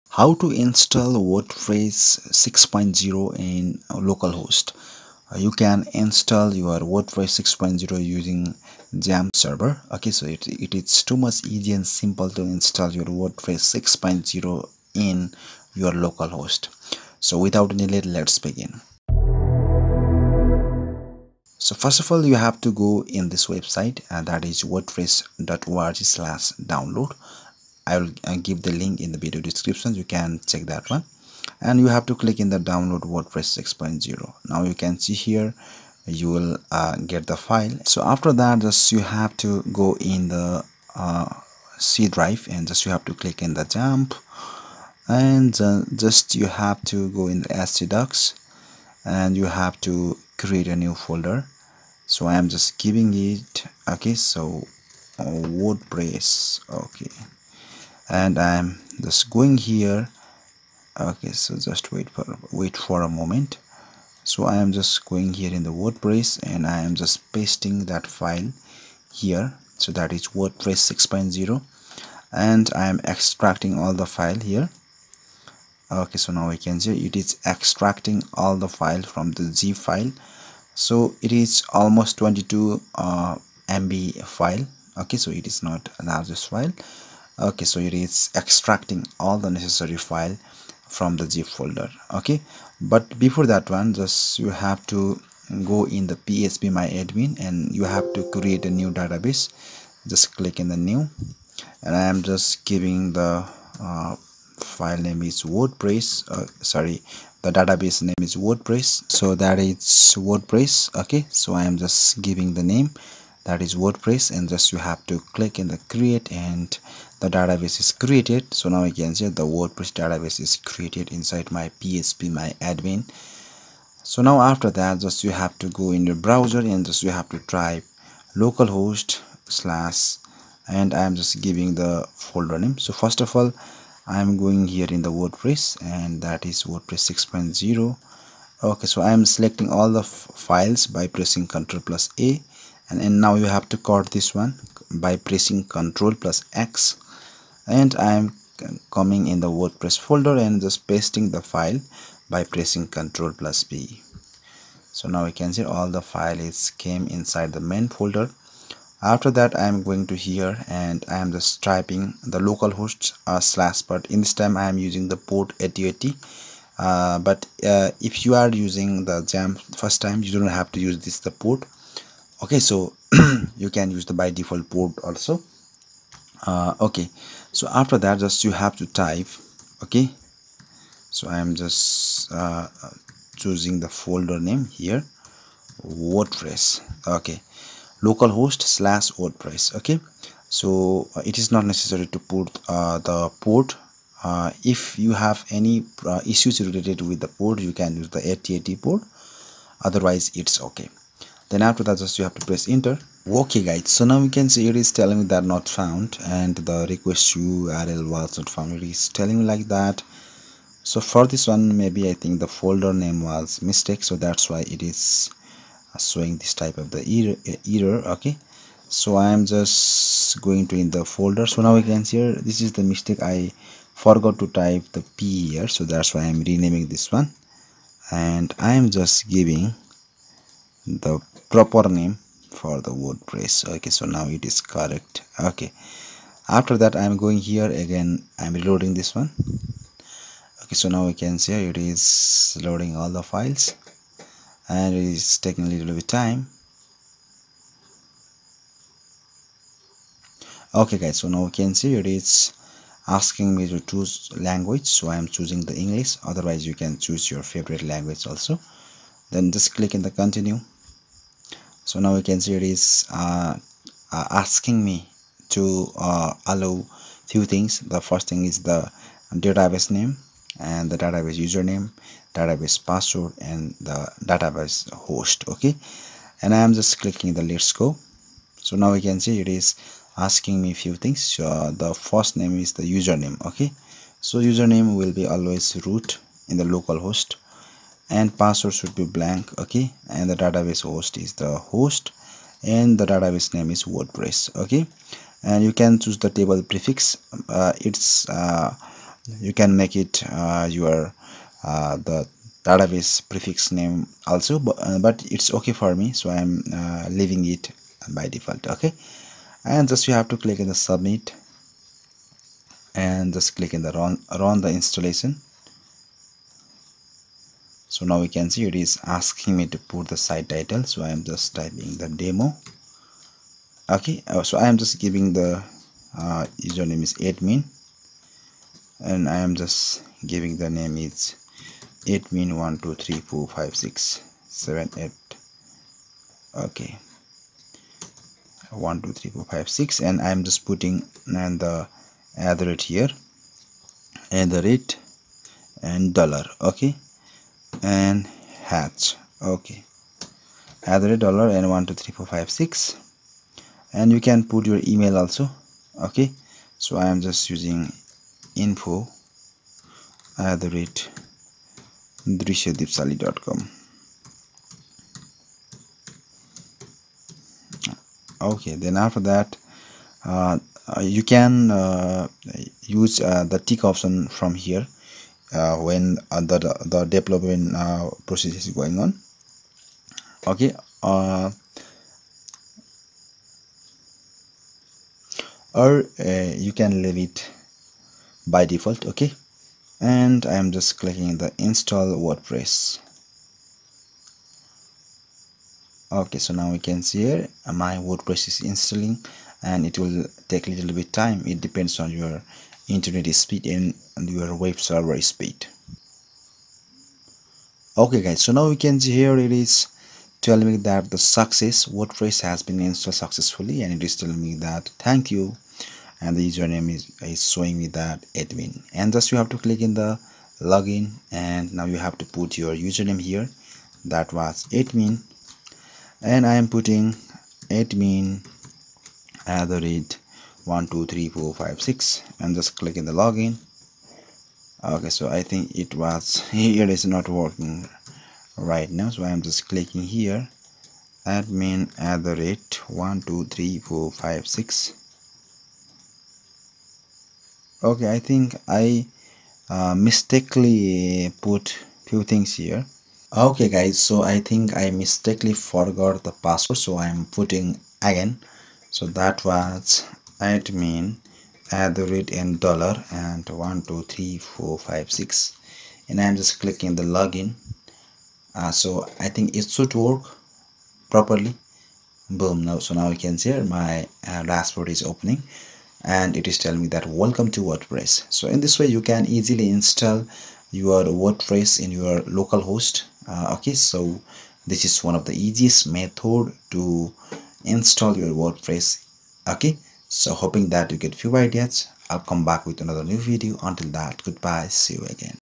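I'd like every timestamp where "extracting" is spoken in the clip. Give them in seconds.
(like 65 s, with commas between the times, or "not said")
73 s, 77 s, 88 s.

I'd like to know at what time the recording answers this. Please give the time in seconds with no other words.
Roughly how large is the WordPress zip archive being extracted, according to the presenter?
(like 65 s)
82 s.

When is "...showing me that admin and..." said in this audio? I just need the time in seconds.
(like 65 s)
417 s.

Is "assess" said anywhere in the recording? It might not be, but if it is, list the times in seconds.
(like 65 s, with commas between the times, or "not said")
not said.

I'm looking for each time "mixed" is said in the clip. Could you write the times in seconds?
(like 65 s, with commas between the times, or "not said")
not said.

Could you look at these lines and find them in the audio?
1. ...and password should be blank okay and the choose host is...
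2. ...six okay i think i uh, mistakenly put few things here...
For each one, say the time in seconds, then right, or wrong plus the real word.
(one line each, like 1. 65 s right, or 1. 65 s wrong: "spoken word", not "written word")
1. 288 s wrong: "database", not "choose"
2. 444 s right.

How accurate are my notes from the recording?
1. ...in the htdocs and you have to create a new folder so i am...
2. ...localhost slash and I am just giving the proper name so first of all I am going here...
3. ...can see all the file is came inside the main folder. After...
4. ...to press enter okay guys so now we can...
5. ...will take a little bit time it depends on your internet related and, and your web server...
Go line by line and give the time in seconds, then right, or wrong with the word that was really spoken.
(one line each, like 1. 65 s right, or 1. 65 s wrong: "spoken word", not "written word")
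1. 47 s right
2. 128 s wrong: "folder", not "proper"
3. 155 s right
4. 202 s right
5. 399 s wrong: "speed", not "related".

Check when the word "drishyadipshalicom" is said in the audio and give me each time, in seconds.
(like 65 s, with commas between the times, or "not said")
362 s.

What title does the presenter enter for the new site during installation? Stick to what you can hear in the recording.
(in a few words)
demo.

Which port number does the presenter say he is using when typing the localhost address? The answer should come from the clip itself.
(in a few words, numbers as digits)
8080.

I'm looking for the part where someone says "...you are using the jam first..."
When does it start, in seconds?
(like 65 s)
168 s.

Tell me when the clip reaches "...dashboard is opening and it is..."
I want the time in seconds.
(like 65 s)
474 s.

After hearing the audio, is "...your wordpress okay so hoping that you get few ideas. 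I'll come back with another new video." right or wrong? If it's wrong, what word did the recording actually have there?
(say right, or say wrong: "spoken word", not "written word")
right.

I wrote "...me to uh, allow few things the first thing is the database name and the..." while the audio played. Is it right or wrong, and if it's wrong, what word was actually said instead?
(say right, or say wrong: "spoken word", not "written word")
right.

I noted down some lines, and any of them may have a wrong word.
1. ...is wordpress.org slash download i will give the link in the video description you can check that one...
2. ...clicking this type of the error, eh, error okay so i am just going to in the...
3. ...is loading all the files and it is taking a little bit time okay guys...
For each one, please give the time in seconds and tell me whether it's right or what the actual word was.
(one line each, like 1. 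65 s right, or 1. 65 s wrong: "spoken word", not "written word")
1. 24 s right
2. 215 s wrong: "showing", not "clicking"
3. 241 s right.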